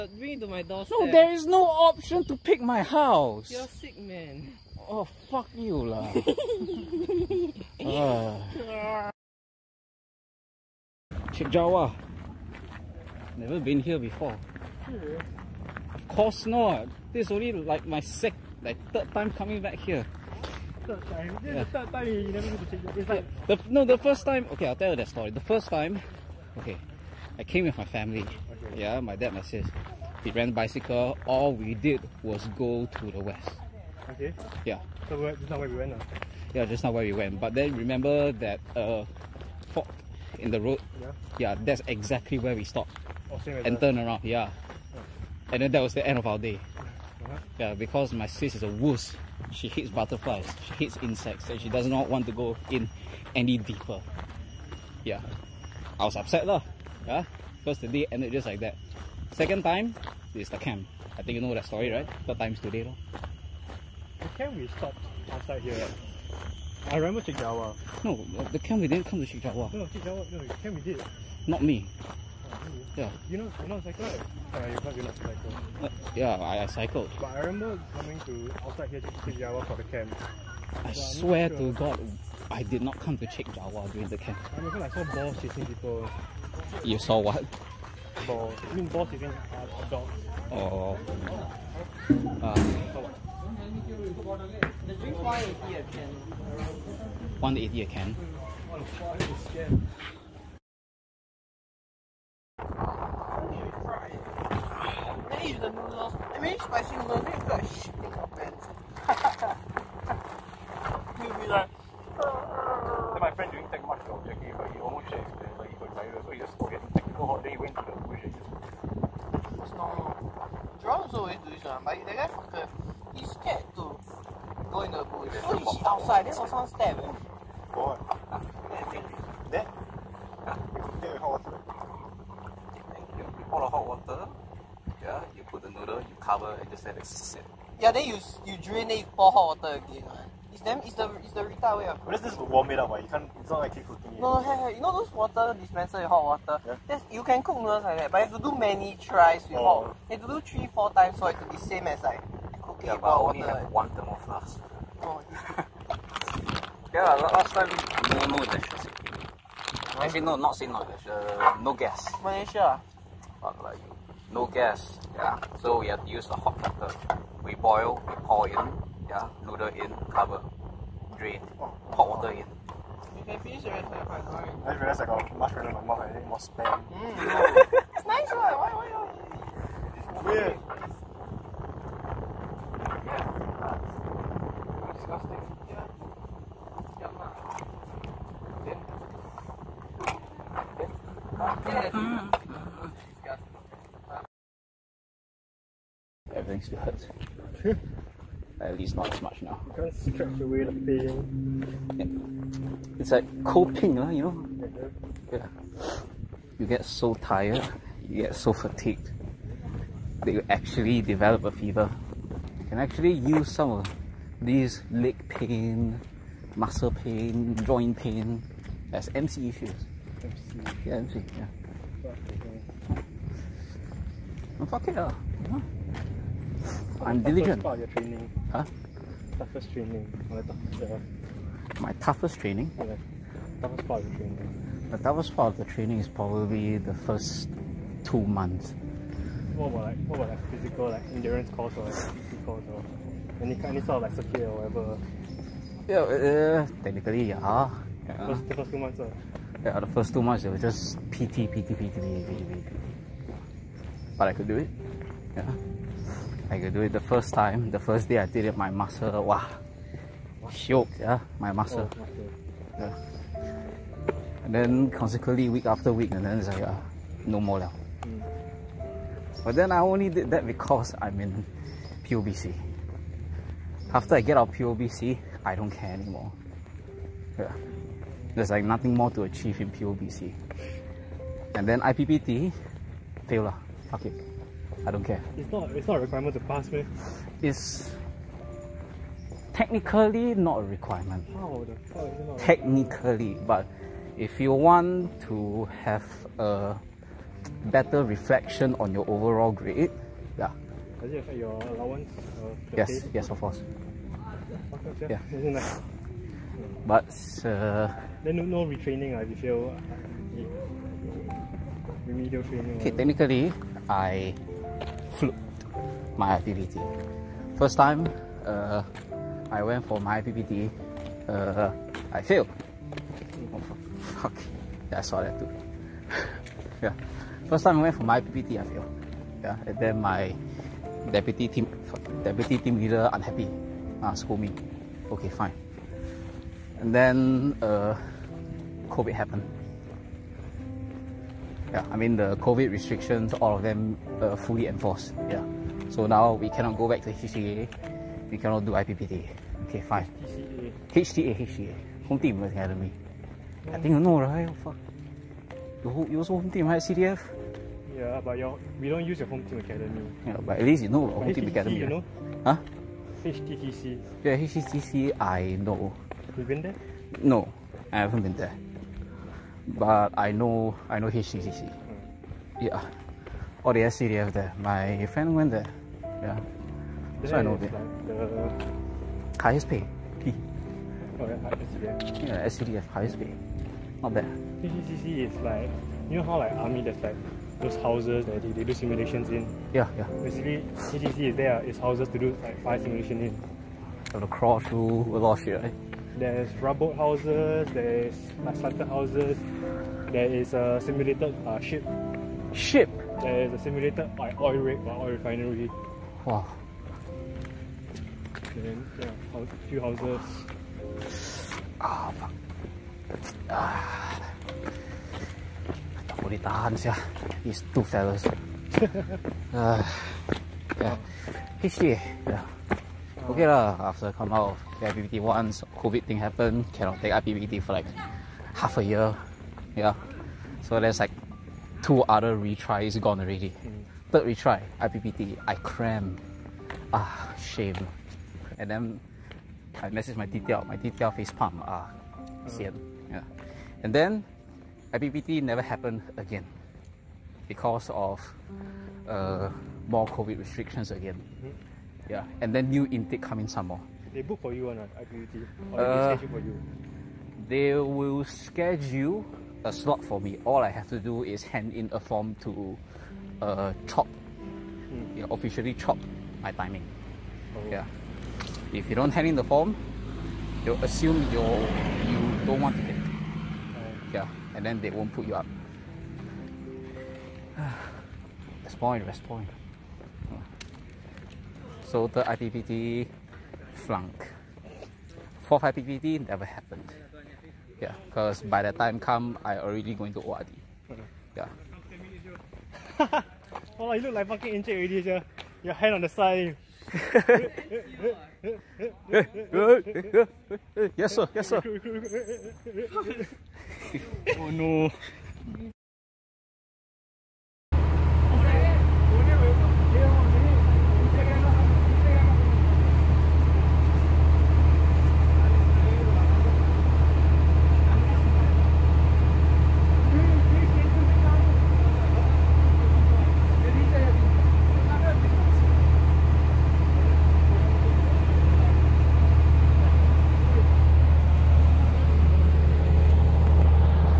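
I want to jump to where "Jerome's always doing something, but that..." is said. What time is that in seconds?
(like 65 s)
120 s.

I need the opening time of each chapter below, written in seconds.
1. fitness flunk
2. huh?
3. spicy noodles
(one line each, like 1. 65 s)
1. 194 s
2. 9 s
3. 100 s.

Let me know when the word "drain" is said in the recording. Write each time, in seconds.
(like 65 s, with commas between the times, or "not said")
138 s, 171 s.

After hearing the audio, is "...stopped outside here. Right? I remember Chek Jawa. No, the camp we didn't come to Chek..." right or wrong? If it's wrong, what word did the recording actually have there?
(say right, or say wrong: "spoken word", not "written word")
right.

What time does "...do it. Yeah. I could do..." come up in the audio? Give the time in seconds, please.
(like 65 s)
254 s.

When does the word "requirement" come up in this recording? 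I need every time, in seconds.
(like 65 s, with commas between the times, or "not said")
285 s, 290 s.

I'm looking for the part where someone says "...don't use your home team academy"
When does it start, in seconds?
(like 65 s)
358 s.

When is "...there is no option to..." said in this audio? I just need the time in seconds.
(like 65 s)
1 s.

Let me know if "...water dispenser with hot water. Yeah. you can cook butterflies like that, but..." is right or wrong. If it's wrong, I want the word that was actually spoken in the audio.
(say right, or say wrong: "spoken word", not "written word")
wrong: "noodles", not "butterflies".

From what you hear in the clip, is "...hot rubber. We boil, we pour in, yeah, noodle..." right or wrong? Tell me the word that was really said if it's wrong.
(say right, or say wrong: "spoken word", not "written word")
wrong: "water", not "rubber".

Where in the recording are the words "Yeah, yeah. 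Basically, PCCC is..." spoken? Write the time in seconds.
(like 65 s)
389 s.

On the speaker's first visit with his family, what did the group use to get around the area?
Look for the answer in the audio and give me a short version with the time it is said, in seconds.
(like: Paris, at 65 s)
Bicycle, at 30 s.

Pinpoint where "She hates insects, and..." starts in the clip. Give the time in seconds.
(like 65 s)
50 s.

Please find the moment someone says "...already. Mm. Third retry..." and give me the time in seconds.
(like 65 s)
433 s.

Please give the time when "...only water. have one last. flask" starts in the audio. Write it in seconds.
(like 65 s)
153 s.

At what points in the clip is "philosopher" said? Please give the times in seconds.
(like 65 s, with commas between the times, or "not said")
not said.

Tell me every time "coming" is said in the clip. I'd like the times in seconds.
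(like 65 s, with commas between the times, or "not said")
19 s, 77 s, 453 s.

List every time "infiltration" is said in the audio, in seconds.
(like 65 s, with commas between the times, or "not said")
not said.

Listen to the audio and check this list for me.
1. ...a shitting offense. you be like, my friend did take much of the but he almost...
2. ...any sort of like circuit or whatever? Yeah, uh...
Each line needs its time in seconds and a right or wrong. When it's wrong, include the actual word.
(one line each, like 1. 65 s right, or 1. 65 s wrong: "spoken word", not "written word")
1. 107 s right
2. 243 s right.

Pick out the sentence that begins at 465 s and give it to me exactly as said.
you know, officially chop my timing.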